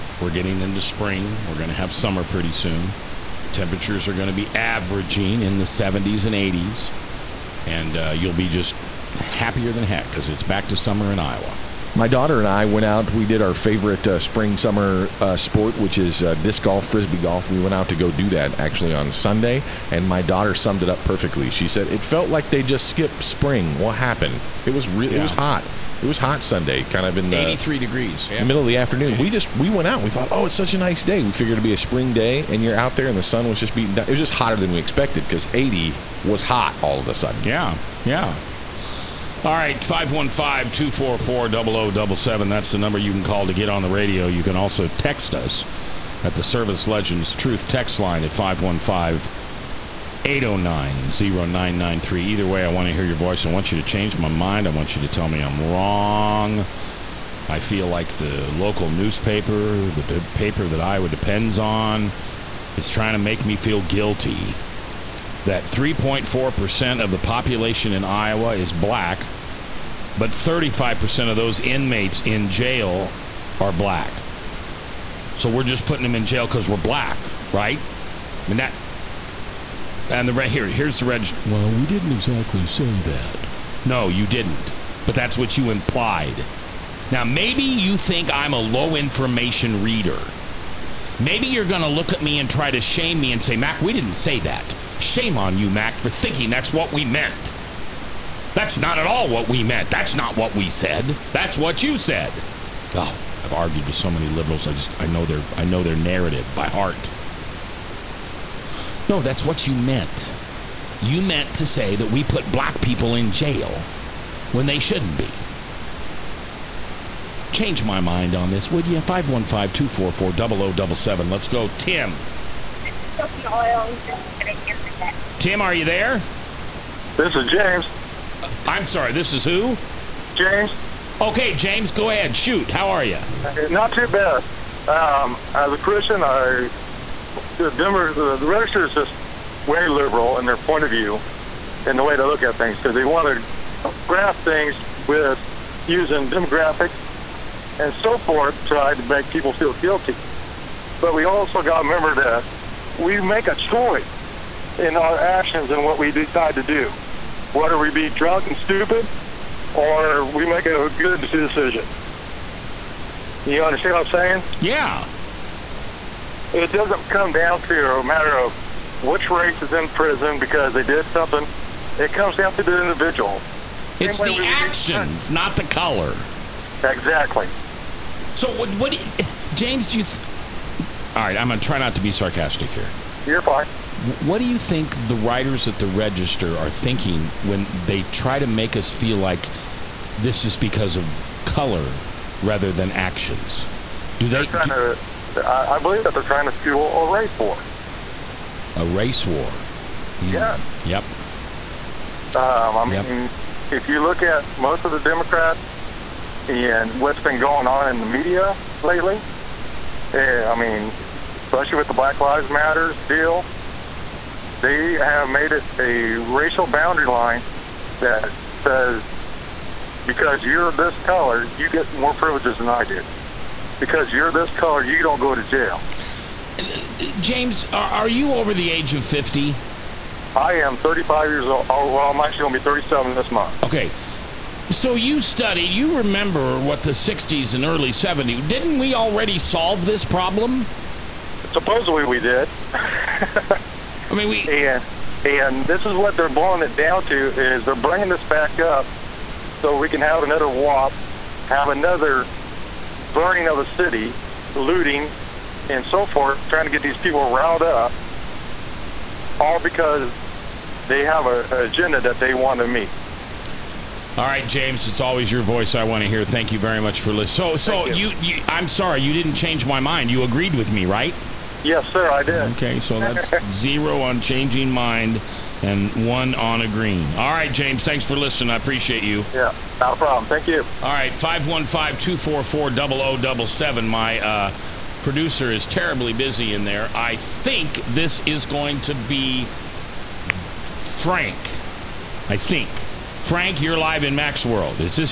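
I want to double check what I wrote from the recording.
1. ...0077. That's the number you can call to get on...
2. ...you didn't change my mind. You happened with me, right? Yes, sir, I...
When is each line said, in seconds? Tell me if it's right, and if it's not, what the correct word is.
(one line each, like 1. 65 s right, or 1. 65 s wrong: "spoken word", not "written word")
1. 41 s right
2. 269 s wrong: "agreed", not "happened".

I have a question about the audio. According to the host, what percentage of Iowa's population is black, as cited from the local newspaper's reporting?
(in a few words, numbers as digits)
3.4%.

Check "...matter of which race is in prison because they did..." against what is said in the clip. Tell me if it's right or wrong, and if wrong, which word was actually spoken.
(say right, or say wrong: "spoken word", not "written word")
right.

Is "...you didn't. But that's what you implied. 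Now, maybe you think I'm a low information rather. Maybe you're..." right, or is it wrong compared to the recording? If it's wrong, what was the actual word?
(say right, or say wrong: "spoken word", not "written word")
wrong: "reader", not "rather".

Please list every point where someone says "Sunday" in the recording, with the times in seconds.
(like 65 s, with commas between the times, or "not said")
19 s, 26 s.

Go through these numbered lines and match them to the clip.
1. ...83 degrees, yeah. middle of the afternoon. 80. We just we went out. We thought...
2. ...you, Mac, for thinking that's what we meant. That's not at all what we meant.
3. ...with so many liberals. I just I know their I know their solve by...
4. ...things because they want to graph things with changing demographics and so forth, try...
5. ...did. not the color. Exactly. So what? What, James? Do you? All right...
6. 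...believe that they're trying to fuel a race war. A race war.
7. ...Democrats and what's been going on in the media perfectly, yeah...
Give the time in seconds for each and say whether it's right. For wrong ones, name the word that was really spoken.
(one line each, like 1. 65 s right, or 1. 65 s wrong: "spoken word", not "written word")
1. 27 s right
2. 95 s right
3. 103 s wrong: "narrative", not "solve"
4. 142 s wrong: "using", not "changing"
5. 175 s right
6. 195 s right
7. 204 s wrong: "lately", not "perfectly".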